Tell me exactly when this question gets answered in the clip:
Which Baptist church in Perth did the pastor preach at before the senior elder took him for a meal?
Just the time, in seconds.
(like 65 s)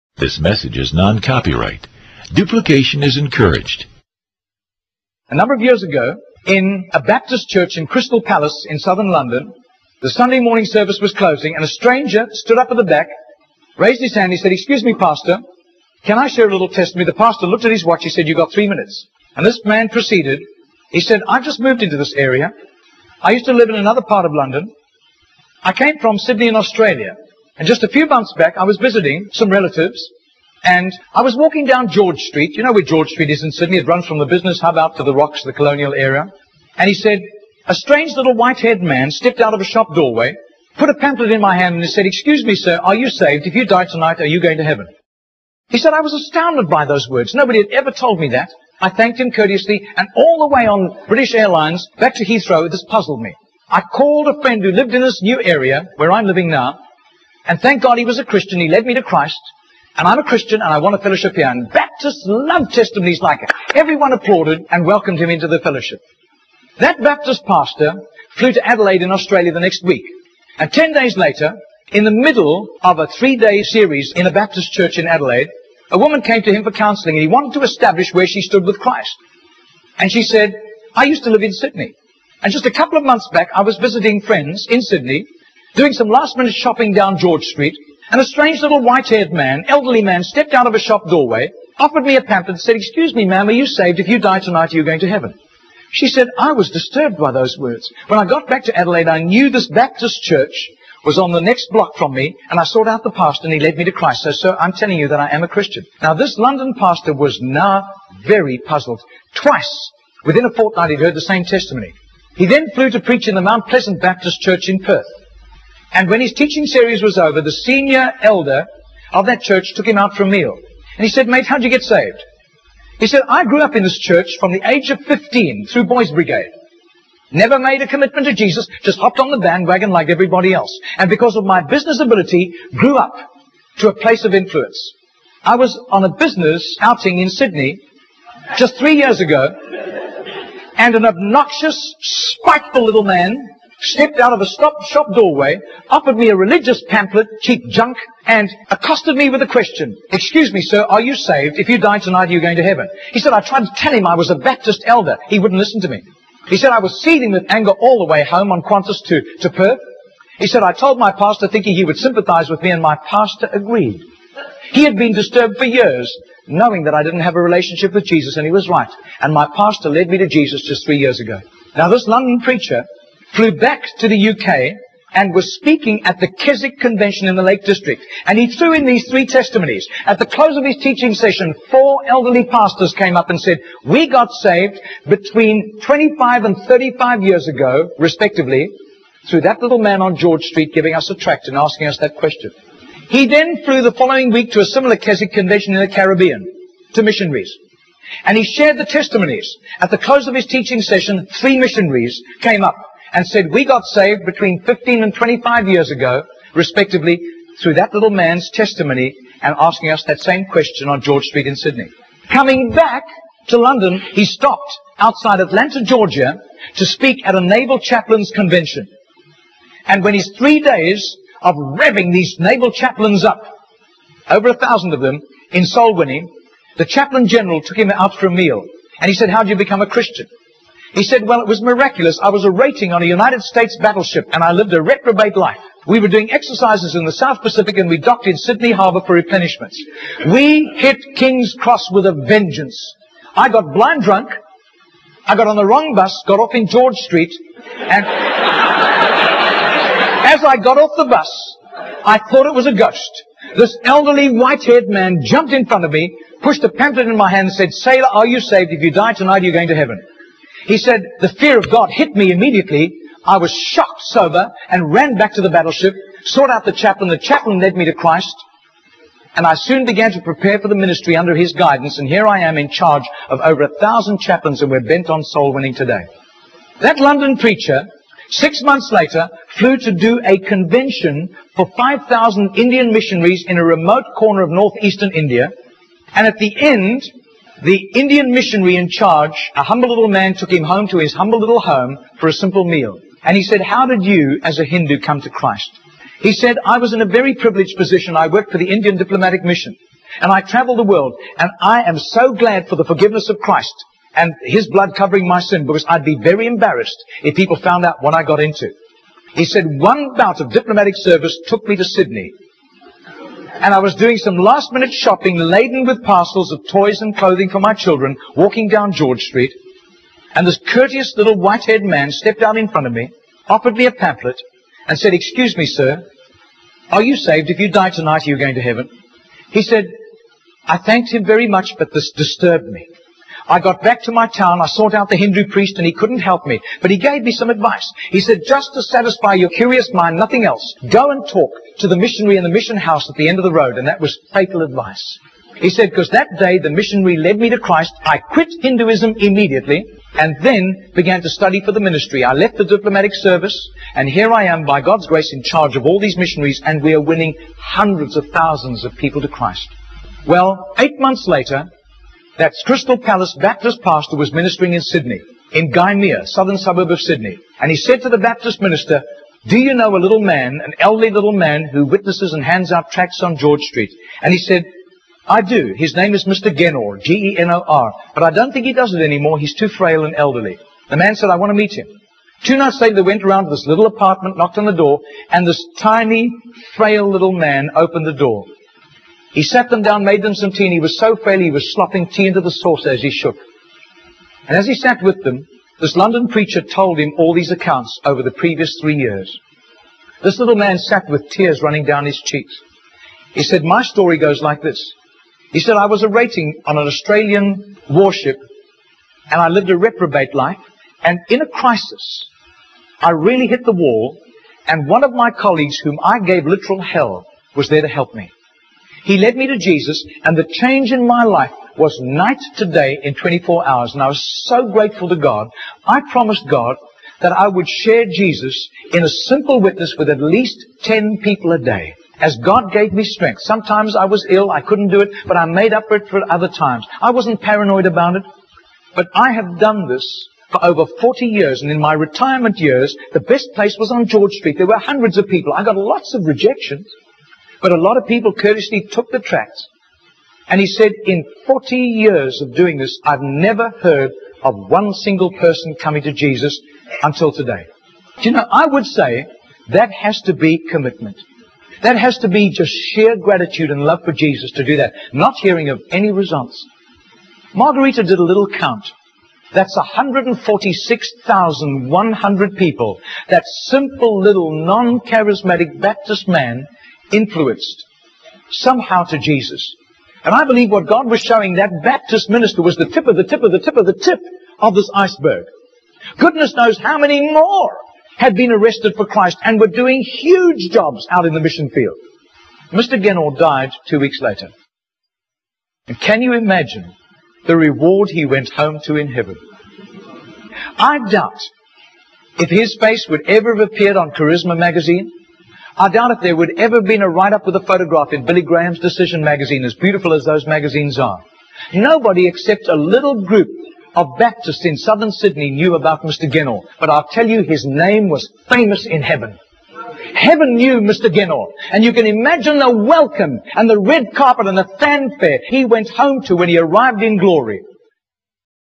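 113 s.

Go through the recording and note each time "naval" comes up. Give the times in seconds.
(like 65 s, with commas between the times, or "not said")
217 s, 222 s.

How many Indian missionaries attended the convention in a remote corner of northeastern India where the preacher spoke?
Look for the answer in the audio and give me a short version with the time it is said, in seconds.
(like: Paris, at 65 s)
5,000, at 281 s.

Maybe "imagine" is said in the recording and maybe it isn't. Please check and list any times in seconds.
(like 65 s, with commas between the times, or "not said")
496 s, 522 s.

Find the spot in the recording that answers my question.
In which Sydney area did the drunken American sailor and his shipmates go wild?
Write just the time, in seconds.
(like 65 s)
241 s.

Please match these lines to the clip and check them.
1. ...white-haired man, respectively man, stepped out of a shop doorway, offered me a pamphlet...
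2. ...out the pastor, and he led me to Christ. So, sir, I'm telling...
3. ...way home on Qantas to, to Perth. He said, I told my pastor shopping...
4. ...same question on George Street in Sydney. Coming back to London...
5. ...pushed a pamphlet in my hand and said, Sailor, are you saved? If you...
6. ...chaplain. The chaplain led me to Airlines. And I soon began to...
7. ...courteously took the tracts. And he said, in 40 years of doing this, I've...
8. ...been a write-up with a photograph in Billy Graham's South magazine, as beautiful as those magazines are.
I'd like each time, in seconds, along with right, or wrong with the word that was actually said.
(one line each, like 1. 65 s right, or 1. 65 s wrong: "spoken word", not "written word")
1. 88 s wrong: "elderly", not "respectively"
2. 102 s right
3. 158 s wrong: "thinking", not "shopping"
4. 210 s right
5. 256 s right
6. 266 s wrong: "Christ", not "Airlines"
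7. 448 s right
8. 506 s wrong: "Decision", not "South".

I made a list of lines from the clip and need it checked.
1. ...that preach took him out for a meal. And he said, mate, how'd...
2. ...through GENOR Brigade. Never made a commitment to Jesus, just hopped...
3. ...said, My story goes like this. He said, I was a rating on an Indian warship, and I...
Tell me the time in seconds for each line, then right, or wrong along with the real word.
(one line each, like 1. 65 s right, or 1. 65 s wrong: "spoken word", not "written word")
1. 119 s wrong: "church", not "preach"
2. 125 s wrong: "Boys", not "GENOR"
3. 403 s wrong: "Australian", not "Indian".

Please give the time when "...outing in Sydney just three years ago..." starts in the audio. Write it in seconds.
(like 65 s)
136 s.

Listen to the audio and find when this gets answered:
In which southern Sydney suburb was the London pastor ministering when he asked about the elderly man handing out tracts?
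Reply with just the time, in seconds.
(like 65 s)
365 s.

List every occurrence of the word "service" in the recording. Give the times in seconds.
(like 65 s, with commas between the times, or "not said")
10 s, 310 s, 353 s.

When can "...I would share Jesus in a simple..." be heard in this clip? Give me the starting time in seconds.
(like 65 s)
427 s.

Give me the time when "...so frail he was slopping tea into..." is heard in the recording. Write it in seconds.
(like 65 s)
390 s.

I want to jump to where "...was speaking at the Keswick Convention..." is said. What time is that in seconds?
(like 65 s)
175 s.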